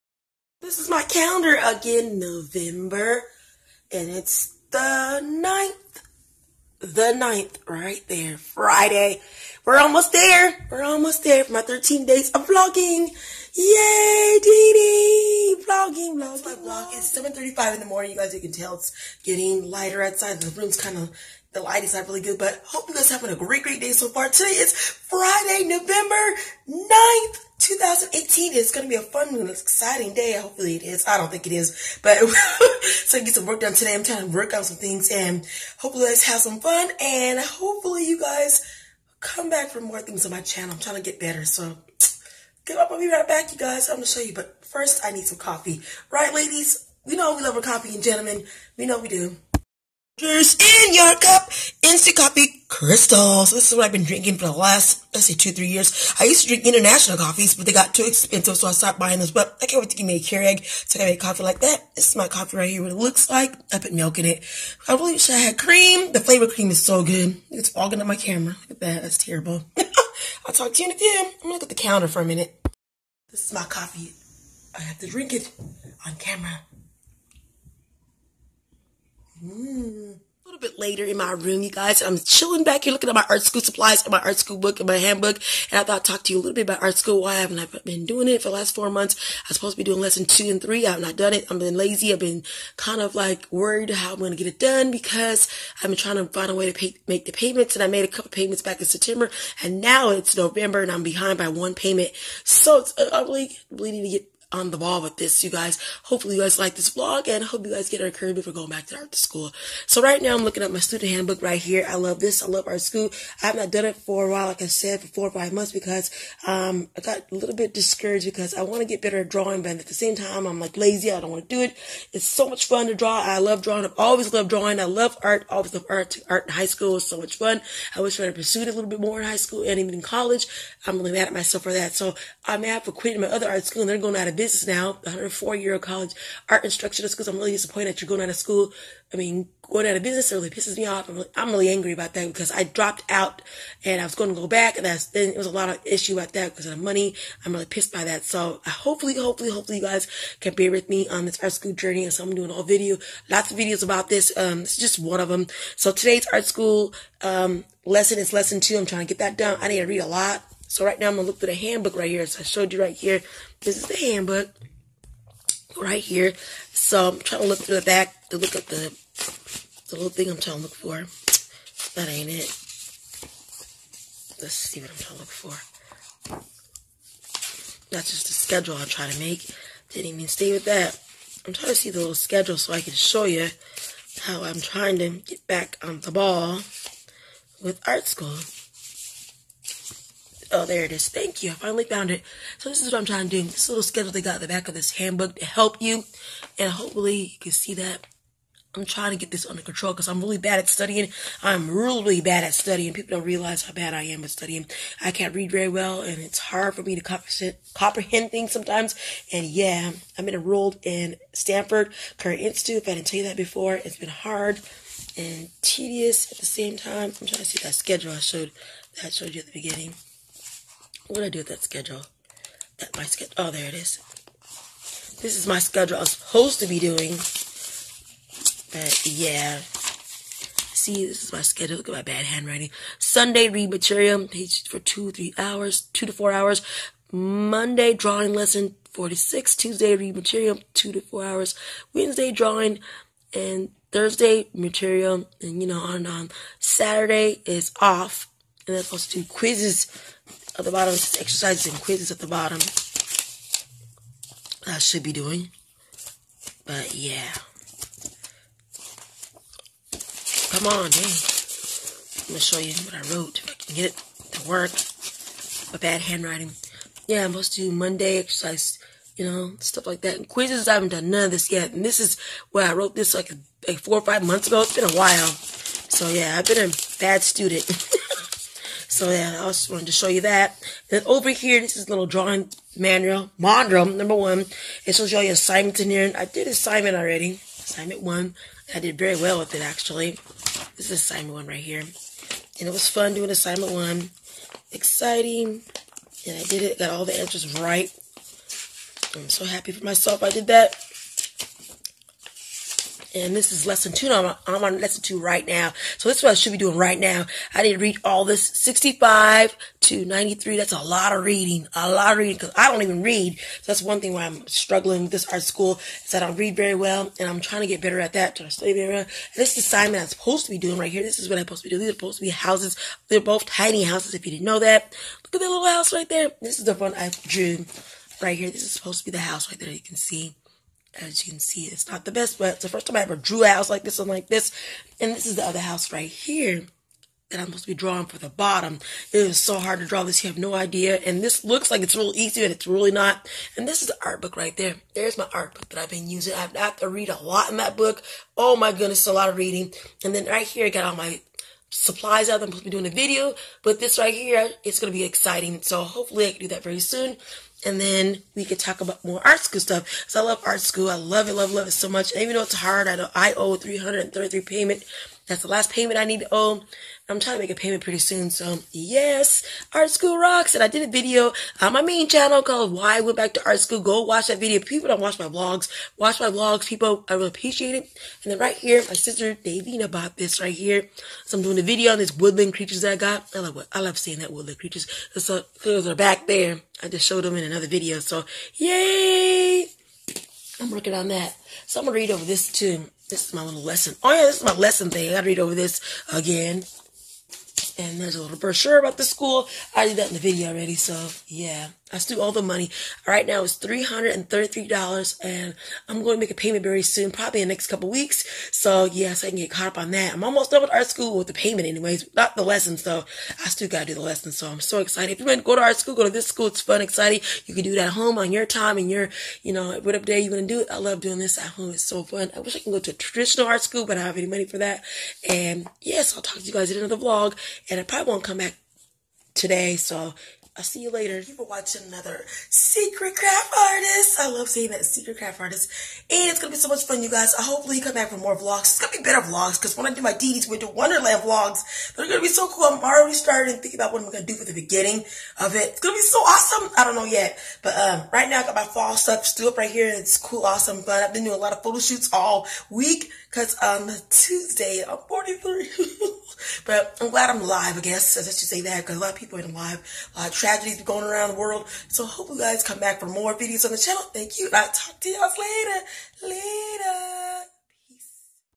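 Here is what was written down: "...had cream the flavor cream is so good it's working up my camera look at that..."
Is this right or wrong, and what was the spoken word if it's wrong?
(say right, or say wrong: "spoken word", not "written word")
wrong: "fogging", not "working".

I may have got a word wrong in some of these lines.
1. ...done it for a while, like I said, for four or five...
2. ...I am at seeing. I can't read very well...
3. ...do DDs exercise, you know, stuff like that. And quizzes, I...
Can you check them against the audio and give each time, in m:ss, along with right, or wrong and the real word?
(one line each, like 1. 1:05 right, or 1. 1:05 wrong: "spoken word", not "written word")
1. 1:53 right
2. 3:23 wrong: "studying", not "seeing"
3. 4:27 wrong: "Monday", not "DDs".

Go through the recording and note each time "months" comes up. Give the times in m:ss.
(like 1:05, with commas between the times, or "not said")
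1:28, 1:55, 4:34.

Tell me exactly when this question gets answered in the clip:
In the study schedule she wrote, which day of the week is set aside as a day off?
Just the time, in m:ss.
4:06.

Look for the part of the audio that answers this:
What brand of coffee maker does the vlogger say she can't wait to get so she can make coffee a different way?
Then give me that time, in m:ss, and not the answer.
1:00.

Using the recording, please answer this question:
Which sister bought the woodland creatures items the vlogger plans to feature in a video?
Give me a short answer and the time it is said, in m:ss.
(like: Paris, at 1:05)
Davina, at 6:19.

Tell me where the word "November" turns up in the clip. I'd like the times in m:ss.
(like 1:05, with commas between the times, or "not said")
0:02, 0:25, 1:40.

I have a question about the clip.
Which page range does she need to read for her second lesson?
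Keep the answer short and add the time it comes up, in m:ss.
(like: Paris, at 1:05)
65 to 93, at 5:08.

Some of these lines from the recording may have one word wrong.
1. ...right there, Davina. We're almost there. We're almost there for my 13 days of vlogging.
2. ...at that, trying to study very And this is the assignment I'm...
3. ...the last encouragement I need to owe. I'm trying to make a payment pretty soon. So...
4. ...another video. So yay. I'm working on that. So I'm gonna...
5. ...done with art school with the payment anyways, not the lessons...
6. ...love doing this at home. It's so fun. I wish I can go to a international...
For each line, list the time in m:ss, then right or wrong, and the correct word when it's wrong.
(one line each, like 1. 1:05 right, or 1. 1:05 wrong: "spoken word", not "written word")
1. 0:07 wrong: "Friday", not "Davina"
2. 5:17 right
3. 6:05 wrong: "payment", not "encouragement"
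4. 6:27 right
5. 6:50 right
6. 7:00 wrong: "traditional", not "international".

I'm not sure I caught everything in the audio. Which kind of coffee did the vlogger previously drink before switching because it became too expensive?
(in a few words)
International coffees.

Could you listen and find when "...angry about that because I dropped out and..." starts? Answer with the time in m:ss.
2:21.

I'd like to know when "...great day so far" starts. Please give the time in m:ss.
0:23.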